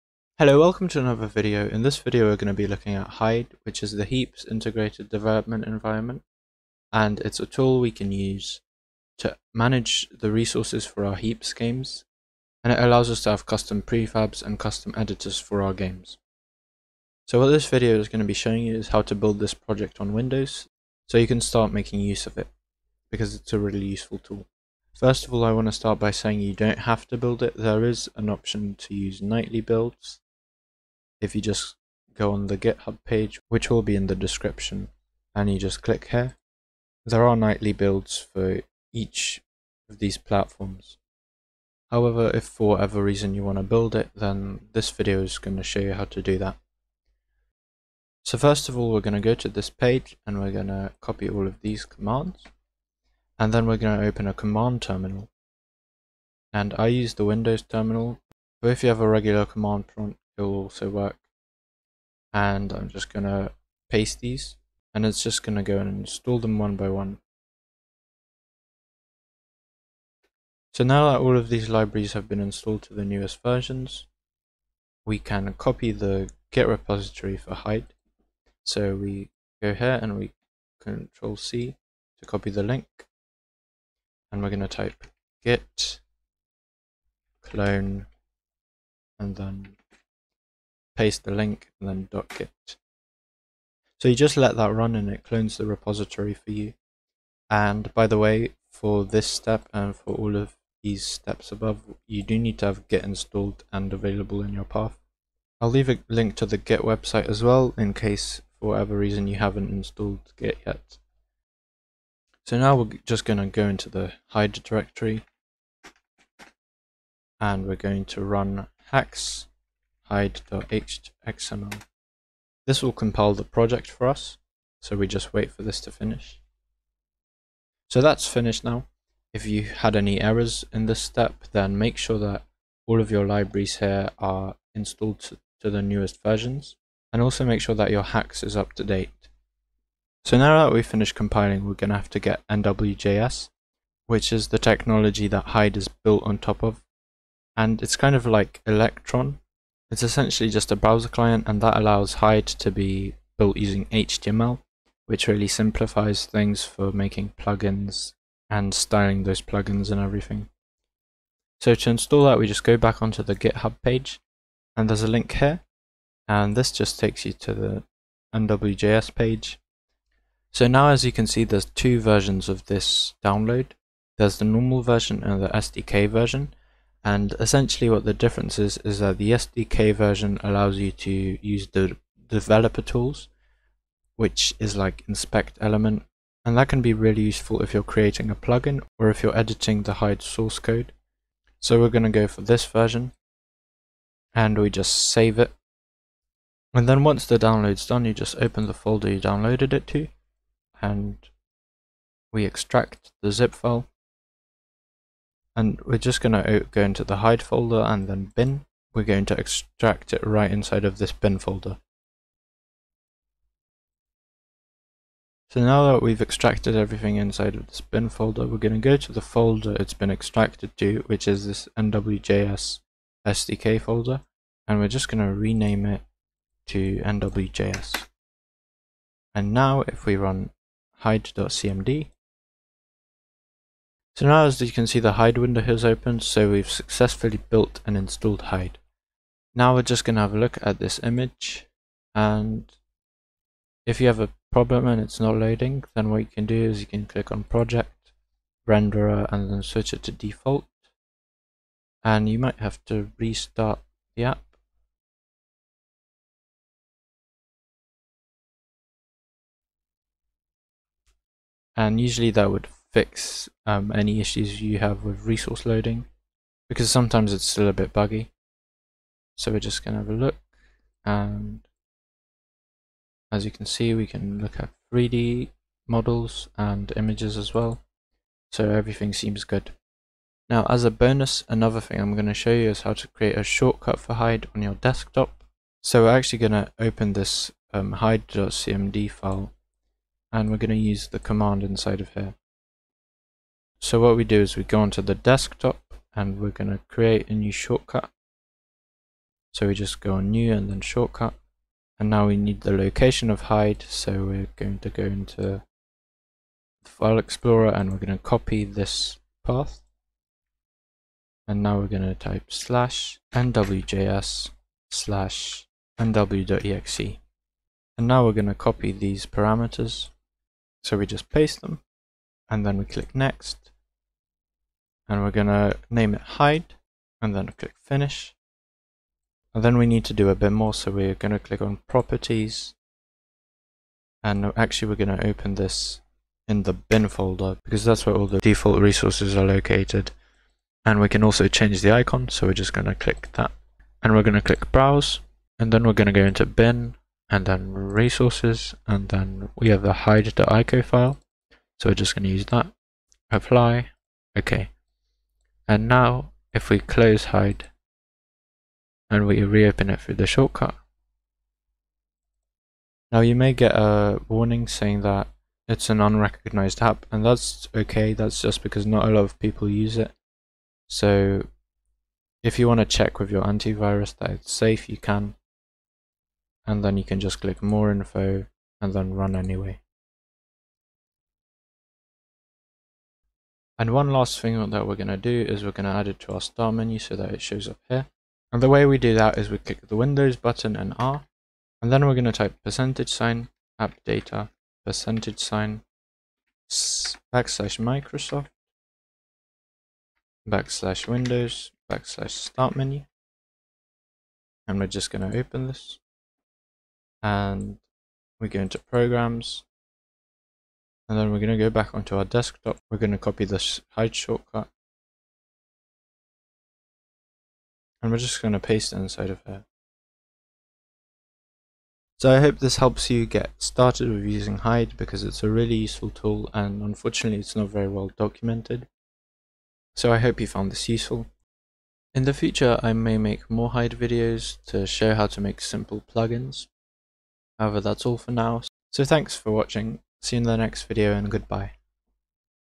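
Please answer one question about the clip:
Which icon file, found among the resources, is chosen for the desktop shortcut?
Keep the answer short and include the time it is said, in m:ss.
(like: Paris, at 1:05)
hide.ico, at 5:50.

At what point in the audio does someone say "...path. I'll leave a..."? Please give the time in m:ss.
1:44.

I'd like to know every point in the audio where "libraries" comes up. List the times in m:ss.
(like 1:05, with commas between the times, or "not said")
1:11, 2:13.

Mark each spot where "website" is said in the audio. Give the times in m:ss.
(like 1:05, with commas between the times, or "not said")
1:46.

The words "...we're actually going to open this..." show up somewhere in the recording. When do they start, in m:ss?
4:46.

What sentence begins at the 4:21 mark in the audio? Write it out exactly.
And usually that would fix um, any issues you have with resource loading because sometimes it's still a bit buggy.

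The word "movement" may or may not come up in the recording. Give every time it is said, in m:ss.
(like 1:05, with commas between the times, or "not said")
not said.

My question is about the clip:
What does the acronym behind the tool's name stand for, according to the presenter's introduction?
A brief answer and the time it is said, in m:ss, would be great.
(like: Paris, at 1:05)
Heaps Integrated Development Environment, at 0:04.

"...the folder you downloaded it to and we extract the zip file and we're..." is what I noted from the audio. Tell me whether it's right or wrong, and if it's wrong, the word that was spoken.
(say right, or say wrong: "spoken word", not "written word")
right.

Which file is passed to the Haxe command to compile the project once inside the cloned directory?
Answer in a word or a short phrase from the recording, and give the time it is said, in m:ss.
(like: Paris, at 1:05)
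hide.xml, at 2:00.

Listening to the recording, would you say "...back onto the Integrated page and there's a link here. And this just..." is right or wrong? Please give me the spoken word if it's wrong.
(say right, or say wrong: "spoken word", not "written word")
wrong: "GitHub", not "Integrated".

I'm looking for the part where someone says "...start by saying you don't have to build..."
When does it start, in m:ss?
0:25.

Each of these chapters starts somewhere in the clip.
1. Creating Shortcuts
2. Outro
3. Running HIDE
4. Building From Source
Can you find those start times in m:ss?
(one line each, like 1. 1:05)
1. 4:40
2. 7:01
3. 3:48
4. 0:41.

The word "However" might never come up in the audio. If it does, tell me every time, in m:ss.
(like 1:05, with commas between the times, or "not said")
0:41, 7:17.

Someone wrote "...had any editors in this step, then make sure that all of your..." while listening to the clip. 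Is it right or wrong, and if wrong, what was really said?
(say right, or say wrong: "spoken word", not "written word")
wrong: "errors", not "editors".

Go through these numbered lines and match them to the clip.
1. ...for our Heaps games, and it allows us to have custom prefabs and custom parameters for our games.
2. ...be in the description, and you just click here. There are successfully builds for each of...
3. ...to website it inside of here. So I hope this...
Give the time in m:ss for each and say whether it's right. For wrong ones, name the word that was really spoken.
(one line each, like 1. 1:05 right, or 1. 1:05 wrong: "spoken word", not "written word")
1. 0:10 wrong: "editors", not "parameters"
2. 0:33 wrong: "nightly", not "successfully"
3. 6:58 wrong: "paste", not "website".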